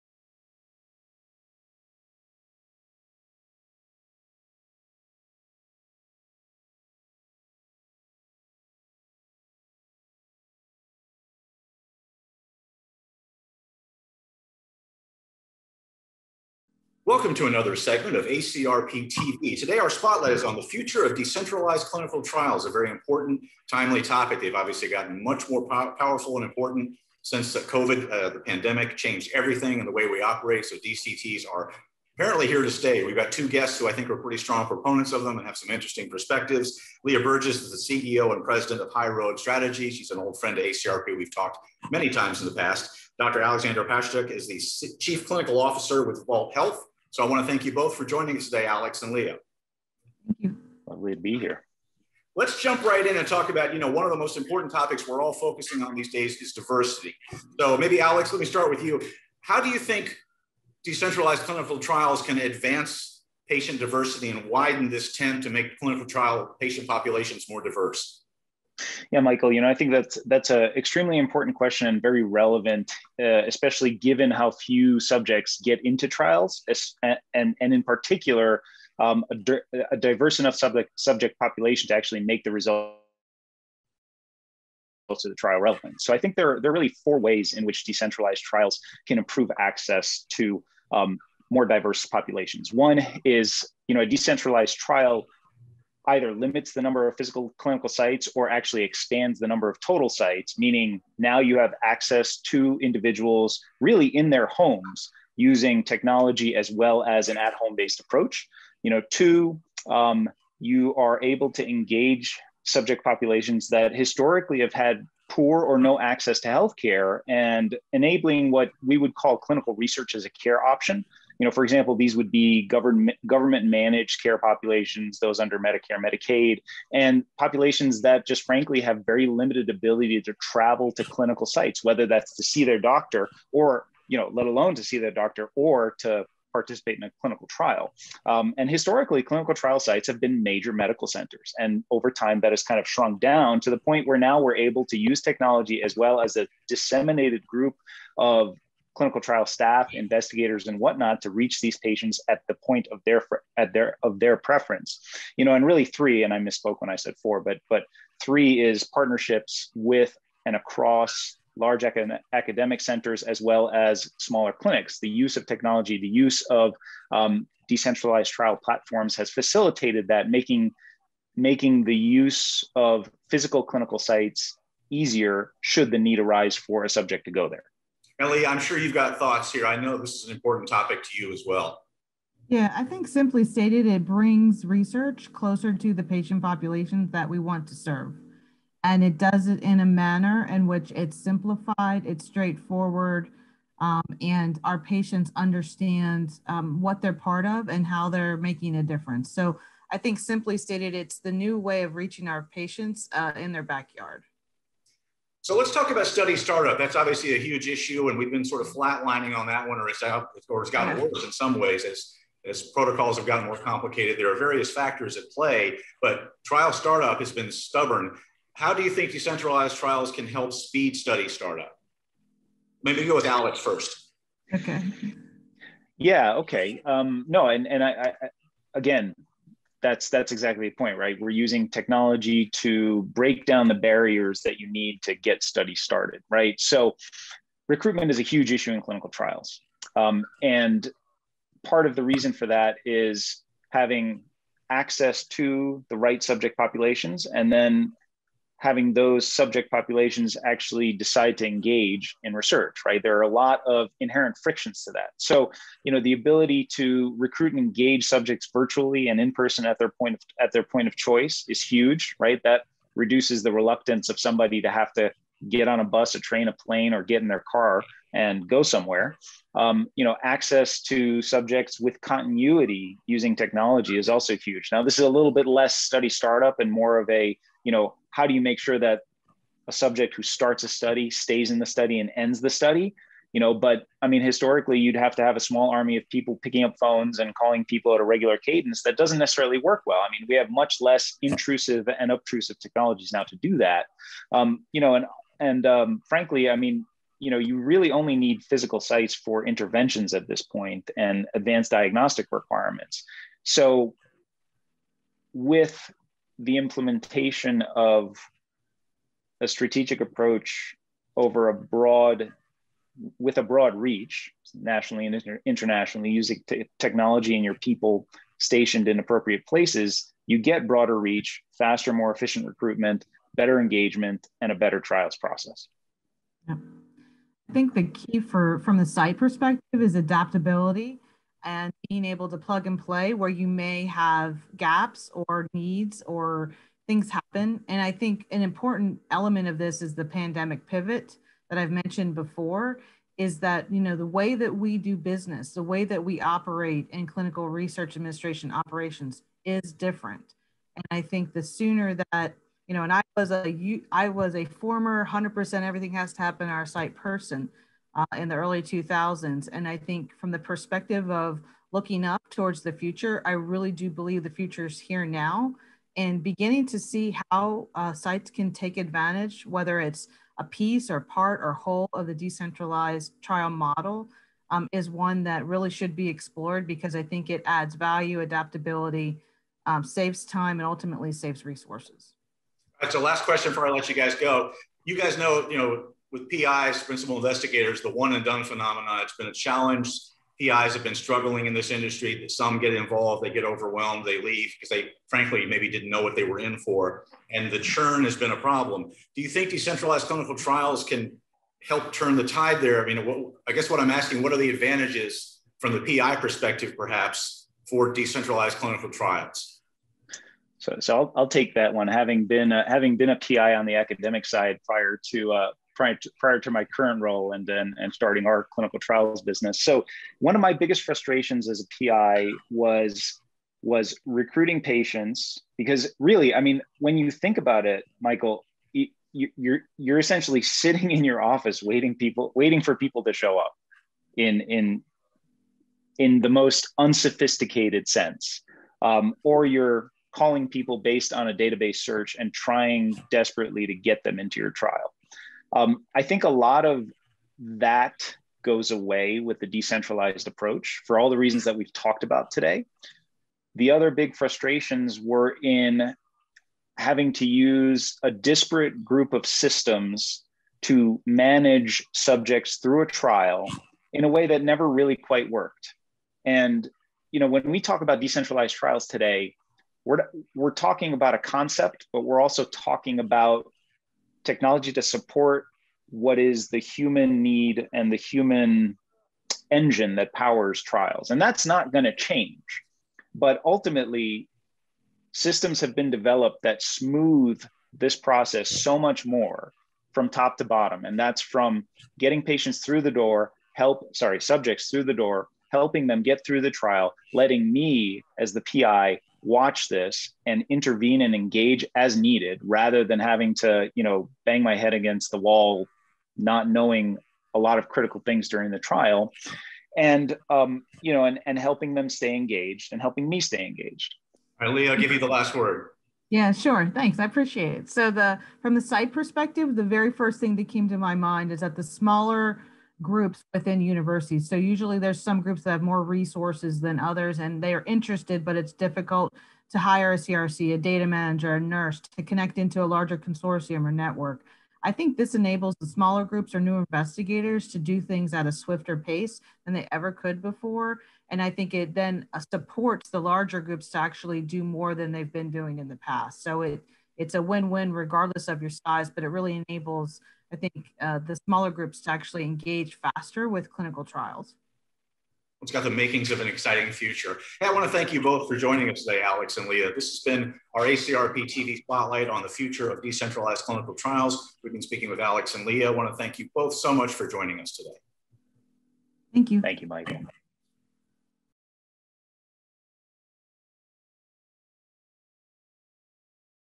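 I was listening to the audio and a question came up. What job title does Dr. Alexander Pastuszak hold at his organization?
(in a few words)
Chief clinical officer.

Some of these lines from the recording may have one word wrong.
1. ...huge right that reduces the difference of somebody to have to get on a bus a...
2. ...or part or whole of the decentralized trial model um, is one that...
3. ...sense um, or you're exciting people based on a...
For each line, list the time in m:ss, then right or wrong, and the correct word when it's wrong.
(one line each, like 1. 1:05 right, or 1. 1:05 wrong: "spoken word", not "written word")
1. 4:21 wrong: "reluctance", not "difference"
2. 6:10 right
3. 7:17 wrong: "calling", not "exciting".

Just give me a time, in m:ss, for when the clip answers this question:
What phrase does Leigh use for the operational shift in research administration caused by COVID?
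5:40.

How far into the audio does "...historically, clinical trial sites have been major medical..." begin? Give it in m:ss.
2:18.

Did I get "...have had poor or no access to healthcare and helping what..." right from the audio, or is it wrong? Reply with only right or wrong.
wrong.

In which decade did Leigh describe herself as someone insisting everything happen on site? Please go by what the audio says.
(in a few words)
Early 2000s.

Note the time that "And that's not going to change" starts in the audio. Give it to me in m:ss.
8:01.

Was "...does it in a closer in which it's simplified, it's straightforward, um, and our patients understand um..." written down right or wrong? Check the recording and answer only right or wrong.
wrong.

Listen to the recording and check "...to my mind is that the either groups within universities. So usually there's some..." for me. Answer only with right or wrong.
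wrong.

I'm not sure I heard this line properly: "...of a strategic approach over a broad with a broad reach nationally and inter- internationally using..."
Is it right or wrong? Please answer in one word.
right.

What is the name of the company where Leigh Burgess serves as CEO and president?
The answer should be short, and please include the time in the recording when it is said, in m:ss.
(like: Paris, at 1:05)
High Road Strategy, at 0:38.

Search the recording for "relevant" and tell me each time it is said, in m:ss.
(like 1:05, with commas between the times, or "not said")
1:12, 1:25.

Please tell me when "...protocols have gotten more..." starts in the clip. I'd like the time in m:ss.
3:32.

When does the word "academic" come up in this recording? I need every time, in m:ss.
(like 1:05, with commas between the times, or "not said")
2:41, 6:53.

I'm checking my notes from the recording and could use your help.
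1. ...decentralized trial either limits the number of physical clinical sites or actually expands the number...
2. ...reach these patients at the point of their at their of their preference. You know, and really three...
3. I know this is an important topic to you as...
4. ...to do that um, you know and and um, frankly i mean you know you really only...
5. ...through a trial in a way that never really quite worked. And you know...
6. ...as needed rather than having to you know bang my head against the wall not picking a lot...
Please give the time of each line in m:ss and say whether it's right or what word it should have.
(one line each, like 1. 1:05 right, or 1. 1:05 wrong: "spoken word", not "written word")
1. 1:34 right
2. 2:31 right
3. 2:59 right
4. 4:53 right
5. 7:42 right
6. 8:21 wrong: "knowing", not "picking".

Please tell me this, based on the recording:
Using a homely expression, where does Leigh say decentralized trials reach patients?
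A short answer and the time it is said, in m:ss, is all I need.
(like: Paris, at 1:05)
In their backyard, at 3:23.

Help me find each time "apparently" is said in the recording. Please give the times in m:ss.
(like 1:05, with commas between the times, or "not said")
0:32.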